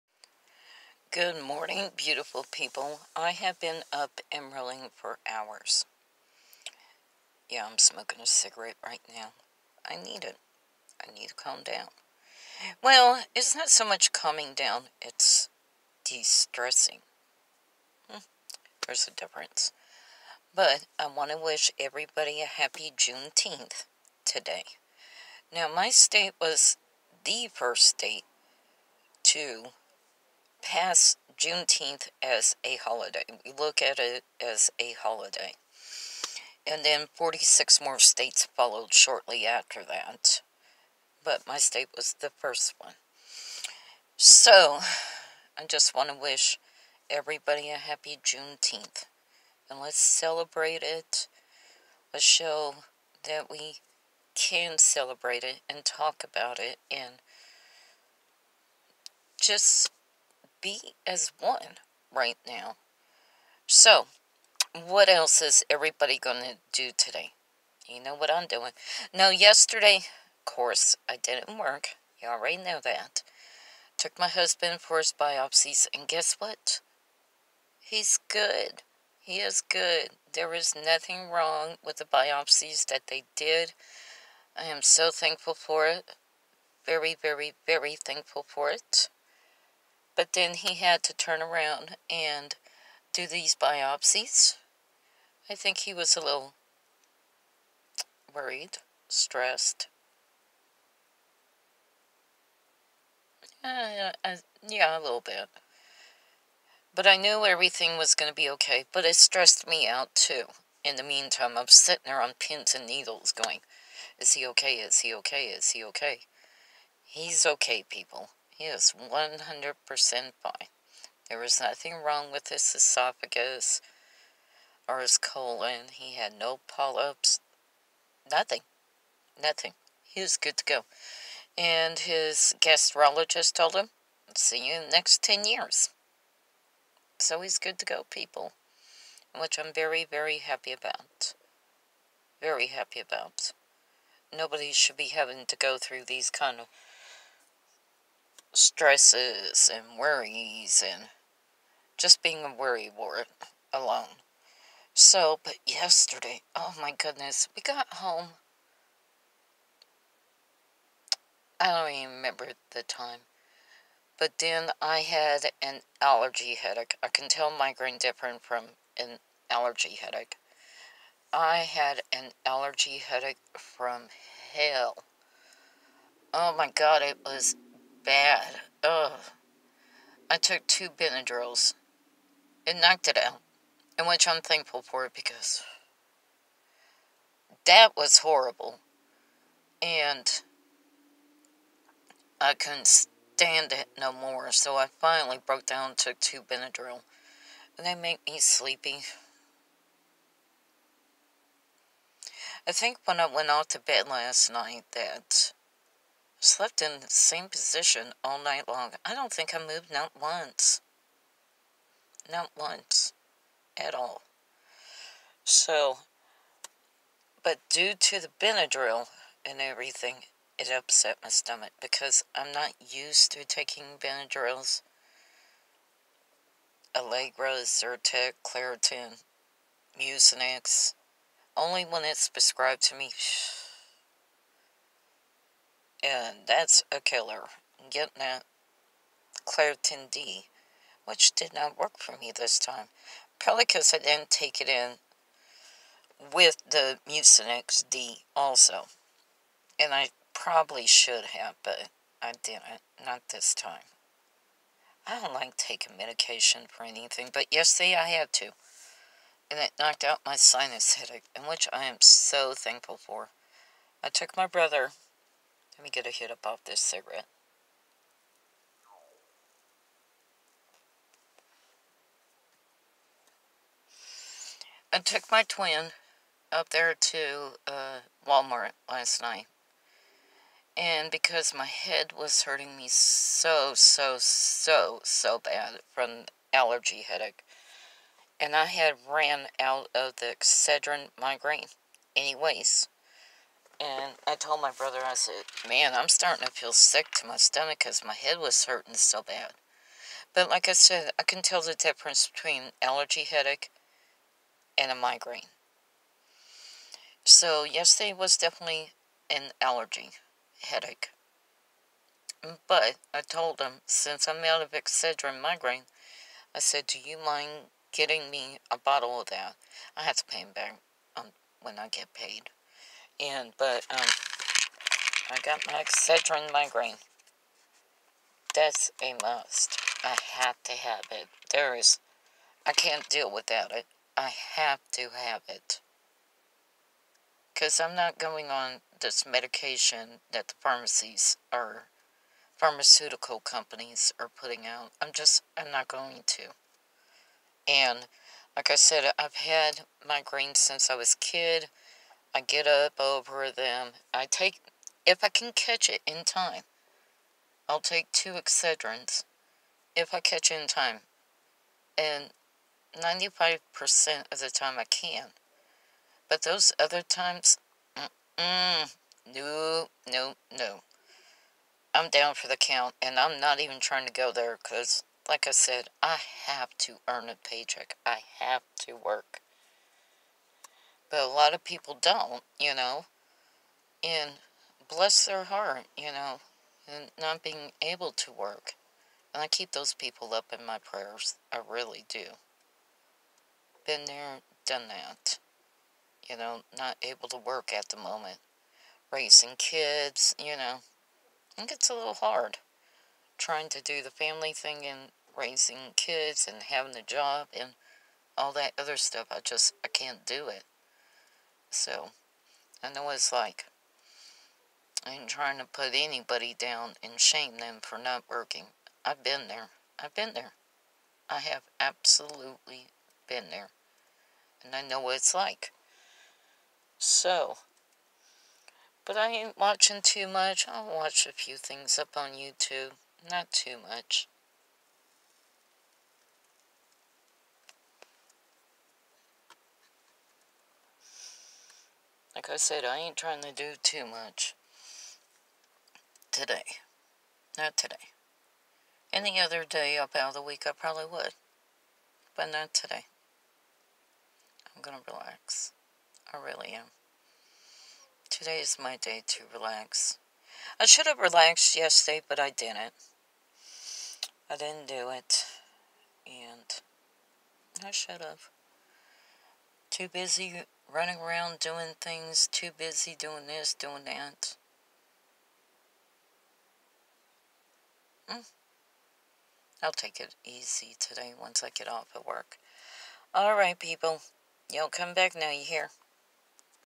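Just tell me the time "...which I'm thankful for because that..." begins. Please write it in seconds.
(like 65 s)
184 s.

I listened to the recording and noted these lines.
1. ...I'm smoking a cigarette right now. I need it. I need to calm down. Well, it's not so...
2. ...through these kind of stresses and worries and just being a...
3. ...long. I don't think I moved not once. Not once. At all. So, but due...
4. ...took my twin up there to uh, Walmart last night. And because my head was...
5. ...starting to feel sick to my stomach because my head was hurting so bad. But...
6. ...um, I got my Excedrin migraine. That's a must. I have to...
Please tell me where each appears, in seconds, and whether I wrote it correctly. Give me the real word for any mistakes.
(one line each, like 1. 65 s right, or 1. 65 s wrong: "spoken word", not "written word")
1. 7 s right
2. 145 s right
3. 208 s right
4. 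274 s right
5. 296 s right
6. 323 s right.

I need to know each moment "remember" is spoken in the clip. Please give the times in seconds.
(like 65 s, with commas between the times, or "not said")
162 s.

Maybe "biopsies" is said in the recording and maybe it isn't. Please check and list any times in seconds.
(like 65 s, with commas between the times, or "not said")
75 s, 82 s, 93 s.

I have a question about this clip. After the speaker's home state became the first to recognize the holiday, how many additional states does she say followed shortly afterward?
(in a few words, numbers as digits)
46.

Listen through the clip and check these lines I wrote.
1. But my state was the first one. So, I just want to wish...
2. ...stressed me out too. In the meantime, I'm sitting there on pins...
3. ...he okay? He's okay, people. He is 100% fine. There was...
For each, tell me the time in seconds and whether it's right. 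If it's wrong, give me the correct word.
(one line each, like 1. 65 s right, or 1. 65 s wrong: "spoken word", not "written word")
1. 41 s right
2. 109 s right
3. 115 s right.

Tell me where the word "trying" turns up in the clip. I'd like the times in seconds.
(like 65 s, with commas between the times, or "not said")
373 s, 403 s, 415 s, 443 s.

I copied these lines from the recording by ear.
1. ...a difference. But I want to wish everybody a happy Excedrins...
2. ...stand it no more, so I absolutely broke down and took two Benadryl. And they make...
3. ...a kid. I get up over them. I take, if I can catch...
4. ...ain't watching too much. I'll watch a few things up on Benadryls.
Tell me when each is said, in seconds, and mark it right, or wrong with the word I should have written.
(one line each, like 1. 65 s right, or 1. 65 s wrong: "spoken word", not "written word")
1. 19 s wrong: "Juneteenth", not "Excedrins"
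2. 192 s wrong: "finally", not "absolutely"
3. 351 s right
4. 429 s wrong: "YouTube", not "Benadryls".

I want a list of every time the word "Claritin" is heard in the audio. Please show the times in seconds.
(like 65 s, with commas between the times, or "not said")
228 s, 239 s.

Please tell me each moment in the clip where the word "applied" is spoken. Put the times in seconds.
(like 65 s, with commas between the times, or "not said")
not said.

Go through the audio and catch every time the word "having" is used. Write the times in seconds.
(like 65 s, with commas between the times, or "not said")
145 s, 406 s.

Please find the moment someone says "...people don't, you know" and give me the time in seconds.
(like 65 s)
381 s.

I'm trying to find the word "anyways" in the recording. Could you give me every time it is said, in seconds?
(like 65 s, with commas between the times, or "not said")
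292 s.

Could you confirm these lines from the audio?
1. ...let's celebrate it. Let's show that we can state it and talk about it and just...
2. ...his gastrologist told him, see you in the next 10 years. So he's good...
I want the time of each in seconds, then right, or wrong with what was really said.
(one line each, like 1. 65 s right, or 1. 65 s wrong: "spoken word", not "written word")
1. 49 s wrong: "celebrate", not "state"
2. 131 s right.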